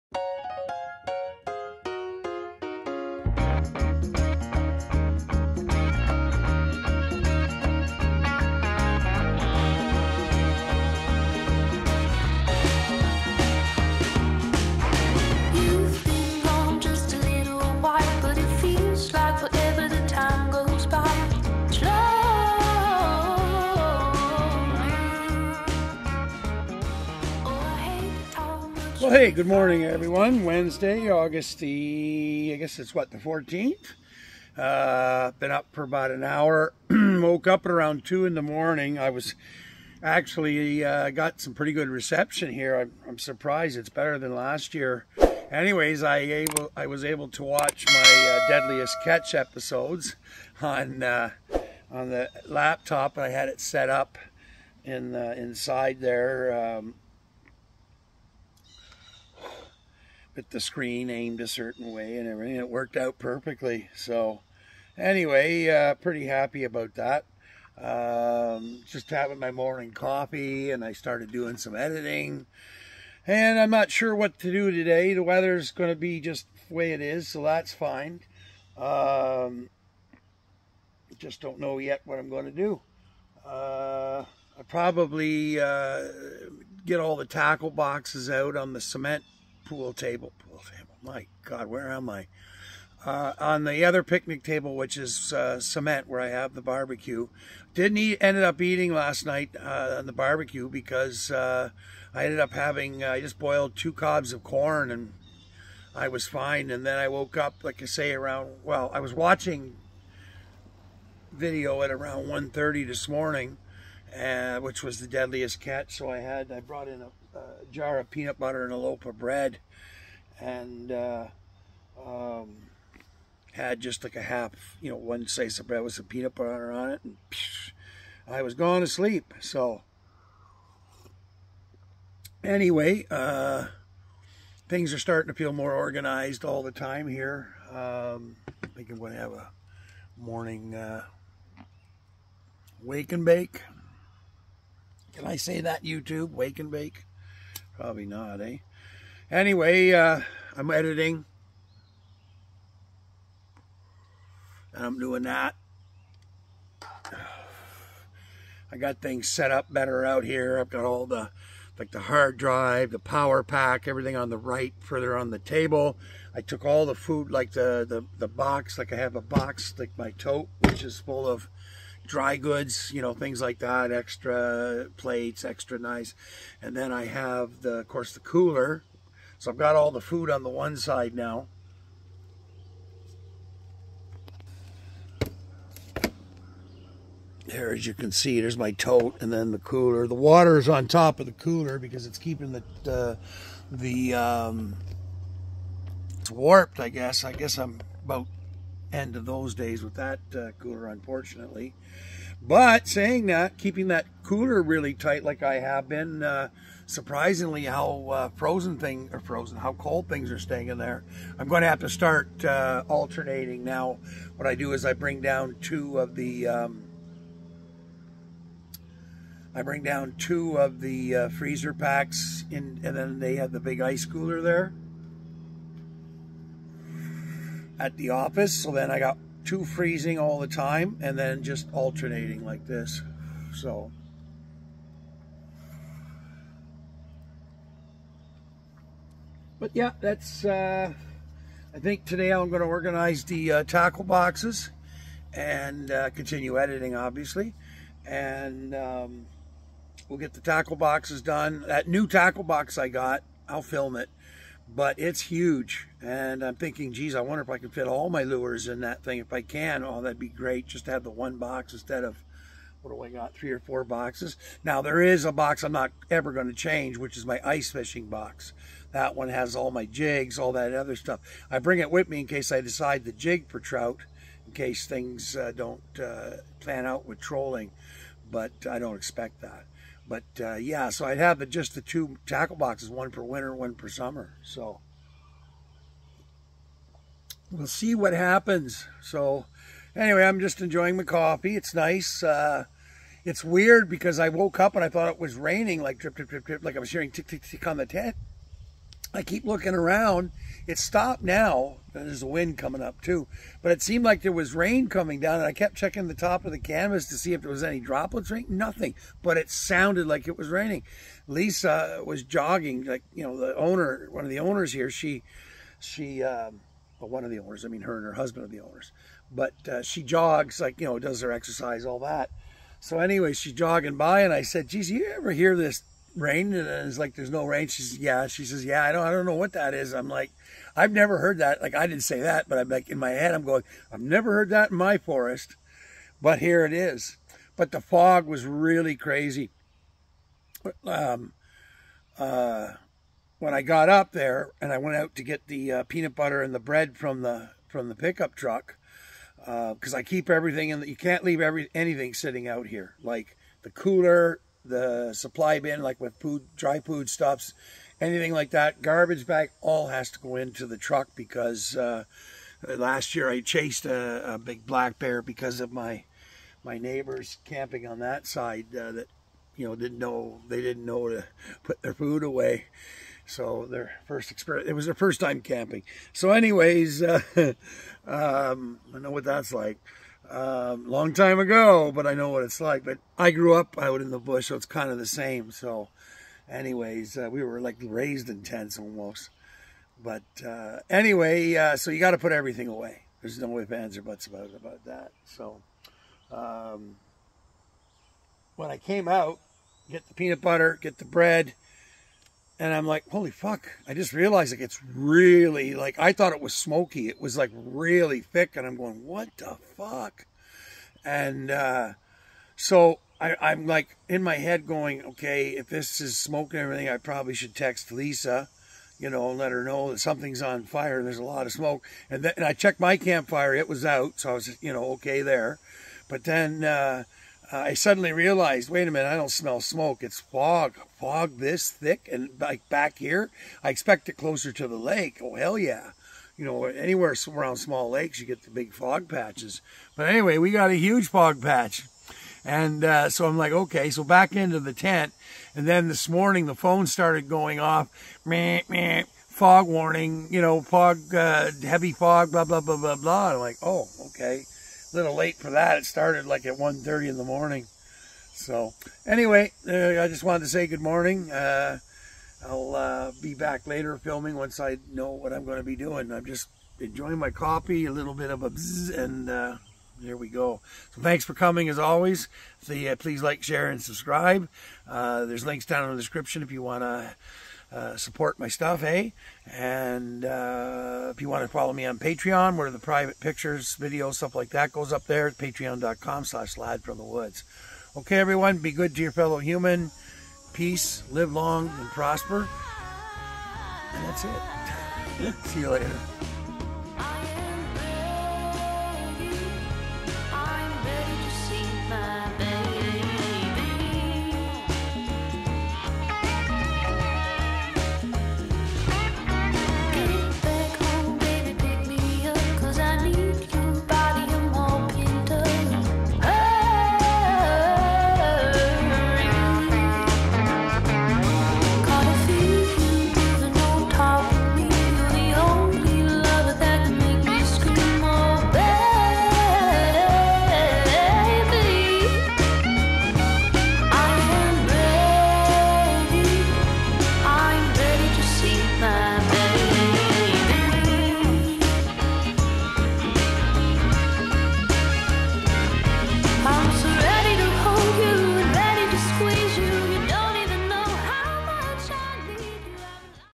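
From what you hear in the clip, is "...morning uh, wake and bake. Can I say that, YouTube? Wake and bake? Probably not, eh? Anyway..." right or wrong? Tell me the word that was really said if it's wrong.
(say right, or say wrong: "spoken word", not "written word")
right.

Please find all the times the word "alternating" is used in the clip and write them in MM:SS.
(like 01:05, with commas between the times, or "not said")
03:32, 03:51.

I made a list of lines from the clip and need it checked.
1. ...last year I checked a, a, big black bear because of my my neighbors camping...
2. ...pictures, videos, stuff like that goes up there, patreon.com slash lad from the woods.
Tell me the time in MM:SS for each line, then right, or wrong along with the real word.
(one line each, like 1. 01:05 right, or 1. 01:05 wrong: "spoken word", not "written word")
1. 06:02 wrong: "chased", not "checked"
2. 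08:03 right.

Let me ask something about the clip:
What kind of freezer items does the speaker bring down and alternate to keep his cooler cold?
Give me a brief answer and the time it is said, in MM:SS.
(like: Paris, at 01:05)
Freezer packs, at 03:41.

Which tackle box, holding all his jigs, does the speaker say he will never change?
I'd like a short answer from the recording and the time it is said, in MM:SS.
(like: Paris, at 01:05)
Ice fishing, at 04:27.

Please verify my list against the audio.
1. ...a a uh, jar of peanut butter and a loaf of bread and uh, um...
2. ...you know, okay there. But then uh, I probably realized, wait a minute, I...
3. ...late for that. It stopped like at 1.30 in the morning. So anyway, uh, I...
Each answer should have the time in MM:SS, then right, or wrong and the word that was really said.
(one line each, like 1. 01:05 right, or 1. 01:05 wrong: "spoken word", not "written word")
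1. 01:57 right
2. 07:04 wrong: "suddenly", not "probably"
3. 07:35 wrong: "started", not "stopped".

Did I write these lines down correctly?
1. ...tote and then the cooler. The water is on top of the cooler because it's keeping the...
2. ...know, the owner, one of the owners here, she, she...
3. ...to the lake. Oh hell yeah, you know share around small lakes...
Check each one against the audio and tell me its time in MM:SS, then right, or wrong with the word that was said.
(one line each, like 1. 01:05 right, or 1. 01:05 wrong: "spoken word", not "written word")
1. 03:08 right
2. 05:13 right
3. 07:14 wrong: "anywhere", not "share".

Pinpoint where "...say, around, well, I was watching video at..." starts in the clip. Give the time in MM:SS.
01:47.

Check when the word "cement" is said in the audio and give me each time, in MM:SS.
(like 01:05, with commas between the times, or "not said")
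01:28, 01:35.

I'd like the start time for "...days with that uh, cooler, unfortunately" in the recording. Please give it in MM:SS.
03:19.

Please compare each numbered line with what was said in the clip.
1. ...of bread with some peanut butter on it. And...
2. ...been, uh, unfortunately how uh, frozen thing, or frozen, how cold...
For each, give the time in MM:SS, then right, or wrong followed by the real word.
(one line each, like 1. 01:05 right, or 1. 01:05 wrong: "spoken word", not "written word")
1. 02:05 right
2. 03:25 wrong: "surprisingly", not "unfortunately".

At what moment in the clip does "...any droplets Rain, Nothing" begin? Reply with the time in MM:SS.
05:07.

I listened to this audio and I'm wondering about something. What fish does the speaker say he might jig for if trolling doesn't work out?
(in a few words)
Trout.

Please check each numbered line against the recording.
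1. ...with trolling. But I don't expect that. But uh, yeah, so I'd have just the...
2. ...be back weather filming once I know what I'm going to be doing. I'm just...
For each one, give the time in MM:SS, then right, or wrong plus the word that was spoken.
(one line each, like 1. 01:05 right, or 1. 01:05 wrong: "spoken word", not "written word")
1. 04:37 right
2. 07:43 wrong: "later", not "weather".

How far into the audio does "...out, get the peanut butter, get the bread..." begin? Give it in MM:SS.
06:39.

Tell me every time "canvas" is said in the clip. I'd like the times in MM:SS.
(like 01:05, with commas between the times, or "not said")
05:06.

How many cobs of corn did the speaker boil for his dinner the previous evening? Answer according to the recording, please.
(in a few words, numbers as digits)
2.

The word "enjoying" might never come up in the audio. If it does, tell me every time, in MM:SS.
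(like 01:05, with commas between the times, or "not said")
04:50, 07:46.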